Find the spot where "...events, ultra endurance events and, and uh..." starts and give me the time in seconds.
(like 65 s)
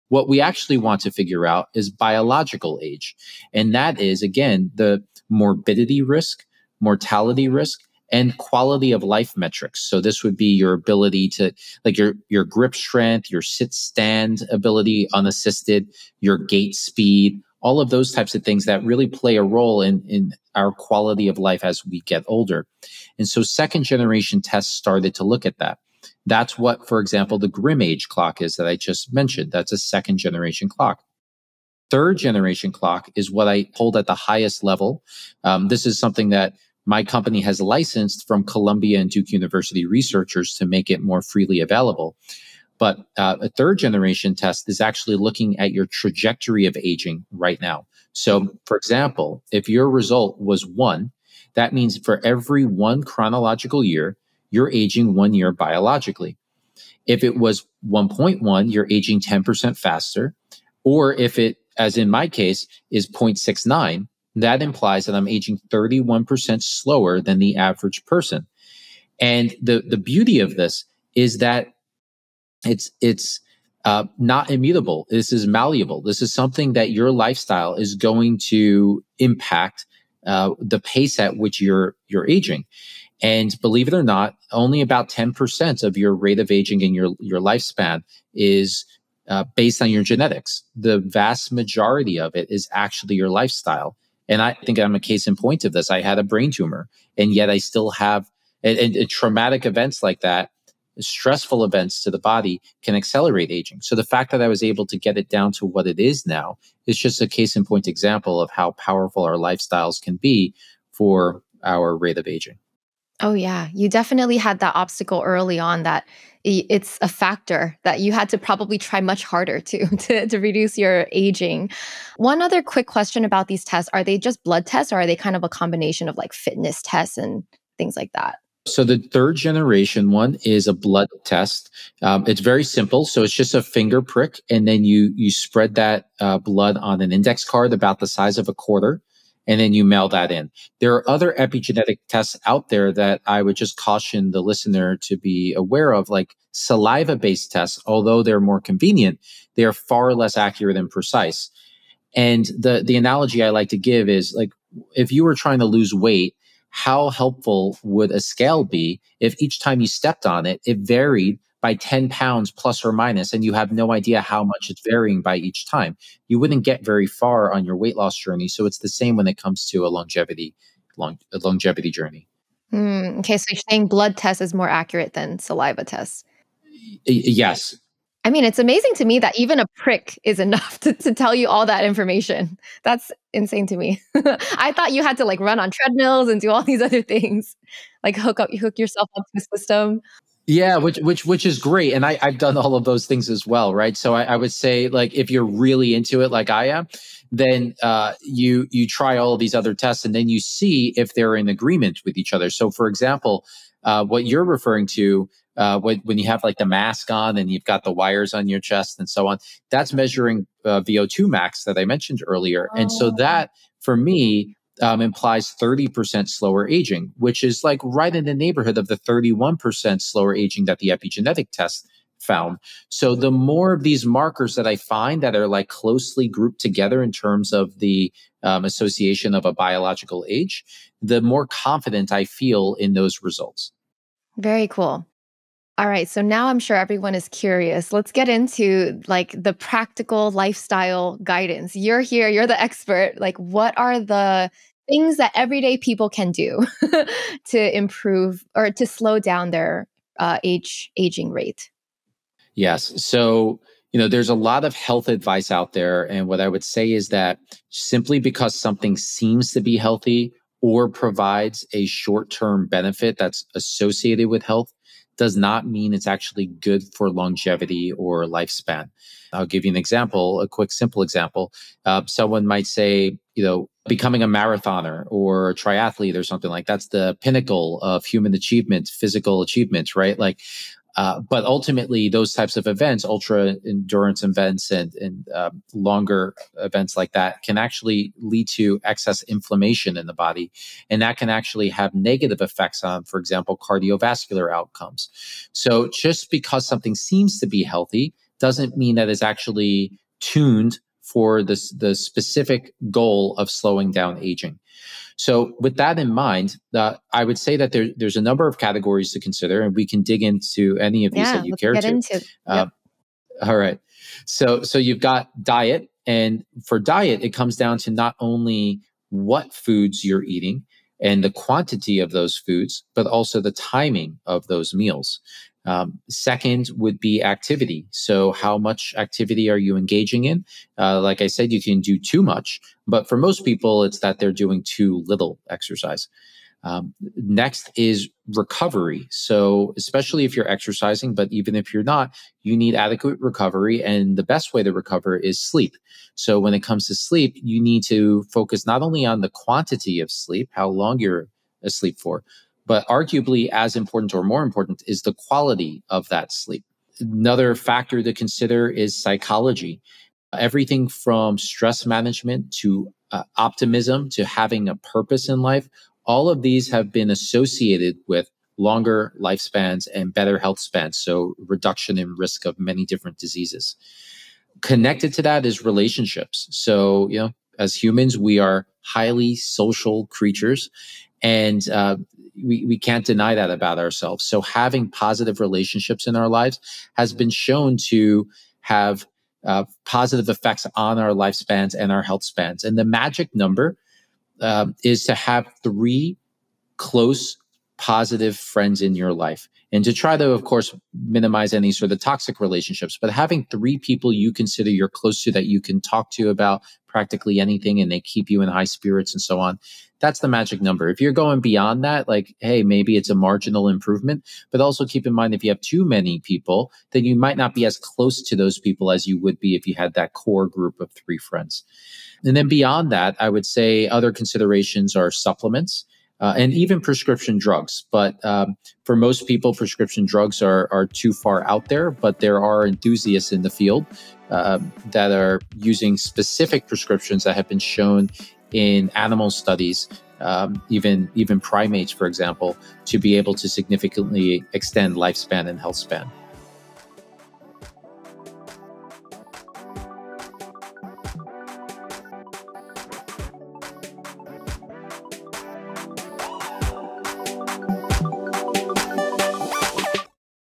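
282 s.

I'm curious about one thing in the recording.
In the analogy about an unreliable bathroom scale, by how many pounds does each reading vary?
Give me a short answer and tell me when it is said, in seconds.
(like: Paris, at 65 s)
10 pounds, at 161 s.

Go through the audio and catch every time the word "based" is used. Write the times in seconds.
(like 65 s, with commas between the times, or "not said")
89 s, 147 s.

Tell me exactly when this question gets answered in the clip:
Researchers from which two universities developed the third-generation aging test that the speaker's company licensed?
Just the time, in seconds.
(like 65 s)
38 s.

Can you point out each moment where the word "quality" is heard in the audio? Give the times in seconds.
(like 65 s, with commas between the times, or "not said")
8 s, 20 s, 355 s.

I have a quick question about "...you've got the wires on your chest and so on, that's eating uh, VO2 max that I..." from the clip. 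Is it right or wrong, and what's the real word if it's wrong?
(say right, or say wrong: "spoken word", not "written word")
wrong: "measuring", not "eating".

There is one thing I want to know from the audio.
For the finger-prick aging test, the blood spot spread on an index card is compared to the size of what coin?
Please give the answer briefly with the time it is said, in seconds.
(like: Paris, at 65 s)
A quarter, at 138 s.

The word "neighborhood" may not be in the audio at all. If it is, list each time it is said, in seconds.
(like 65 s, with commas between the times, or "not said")
218 s.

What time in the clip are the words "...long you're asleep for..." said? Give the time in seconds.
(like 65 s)
350 s.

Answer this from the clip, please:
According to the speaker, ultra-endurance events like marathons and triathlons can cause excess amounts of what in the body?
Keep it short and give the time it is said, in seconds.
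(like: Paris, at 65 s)
Inflammation, at 289 s.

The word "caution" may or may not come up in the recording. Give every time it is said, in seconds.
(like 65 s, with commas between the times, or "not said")
143 s.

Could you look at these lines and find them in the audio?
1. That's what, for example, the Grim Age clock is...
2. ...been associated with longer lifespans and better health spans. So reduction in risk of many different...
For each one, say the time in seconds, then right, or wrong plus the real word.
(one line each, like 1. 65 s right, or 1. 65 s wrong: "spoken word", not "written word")
1. 26 s right
2. 366 s right.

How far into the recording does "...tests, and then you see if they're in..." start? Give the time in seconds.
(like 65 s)
199 s.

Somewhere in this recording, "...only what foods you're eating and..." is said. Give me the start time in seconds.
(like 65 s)
318 s.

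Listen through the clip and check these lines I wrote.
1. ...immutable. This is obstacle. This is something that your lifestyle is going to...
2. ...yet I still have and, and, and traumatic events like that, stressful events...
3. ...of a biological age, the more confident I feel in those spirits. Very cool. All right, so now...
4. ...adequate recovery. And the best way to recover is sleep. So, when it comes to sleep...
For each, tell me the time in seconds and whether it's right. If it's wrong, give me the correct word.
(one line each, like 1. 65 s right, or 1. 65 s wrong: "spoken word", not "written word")
1. 74 s wrong: "malleable", not "obstacle"
2. 97 s right
3. 229 s wrong: "results", not "spirits"
4. 342 s right.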